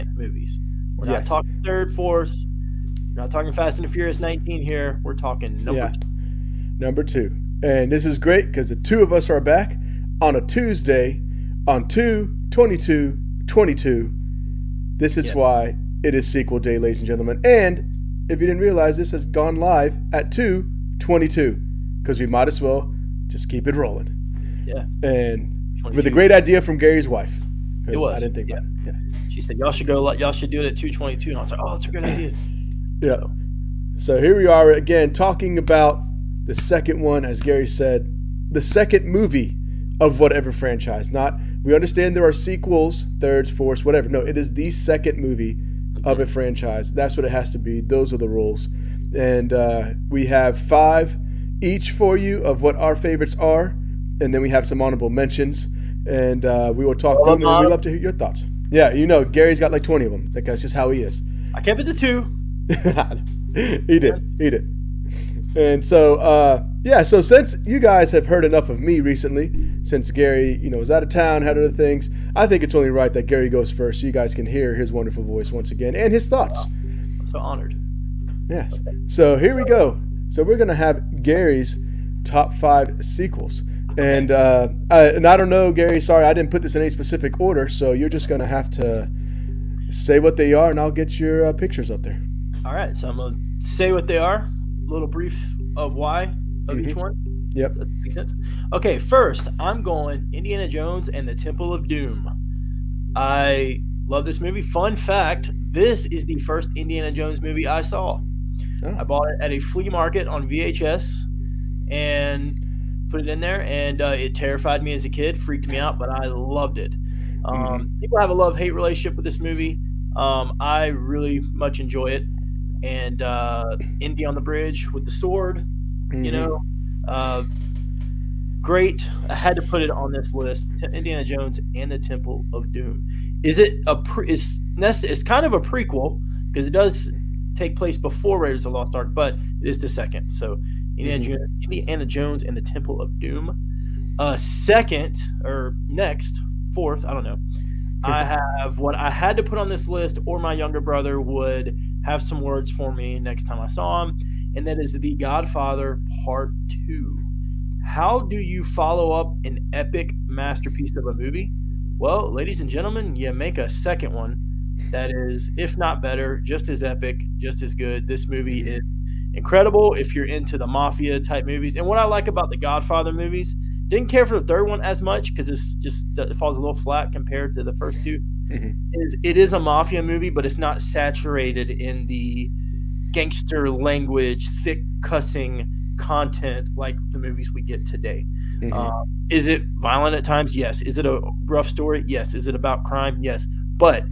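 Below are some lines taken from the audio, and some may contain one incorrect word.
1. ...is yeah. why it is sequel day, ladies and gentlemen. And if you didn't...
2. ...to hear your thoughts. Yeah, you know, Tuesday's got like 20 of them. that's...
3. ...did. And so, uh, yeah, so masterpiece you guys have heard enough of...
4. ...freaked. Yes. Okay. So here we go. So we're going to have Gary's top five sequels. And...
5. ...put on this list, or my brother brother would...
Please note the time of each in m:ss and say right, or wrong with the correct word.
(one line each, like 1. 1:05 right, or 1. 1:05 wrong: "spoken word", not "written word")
1. 0:15 right
2. 0:57 wrong: "Gary", not "Tuesday"
3. 1:04 wrong: "since", not "masterpiece"
4. 1:17 wrong: "honored", not "freaked"
5. 2:29 wrong: "younger", not "brother".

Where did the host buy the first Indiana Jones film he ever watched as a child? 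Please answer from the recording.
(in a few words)
a flea market.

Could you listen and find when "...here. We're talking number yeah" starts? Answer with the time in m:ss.
0:04.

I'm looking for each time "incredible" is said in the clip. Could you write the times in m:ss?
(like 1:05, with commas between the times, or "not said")
2:49.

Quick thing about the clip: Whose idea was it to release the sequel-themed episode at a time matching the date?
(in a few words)
Gary's wife.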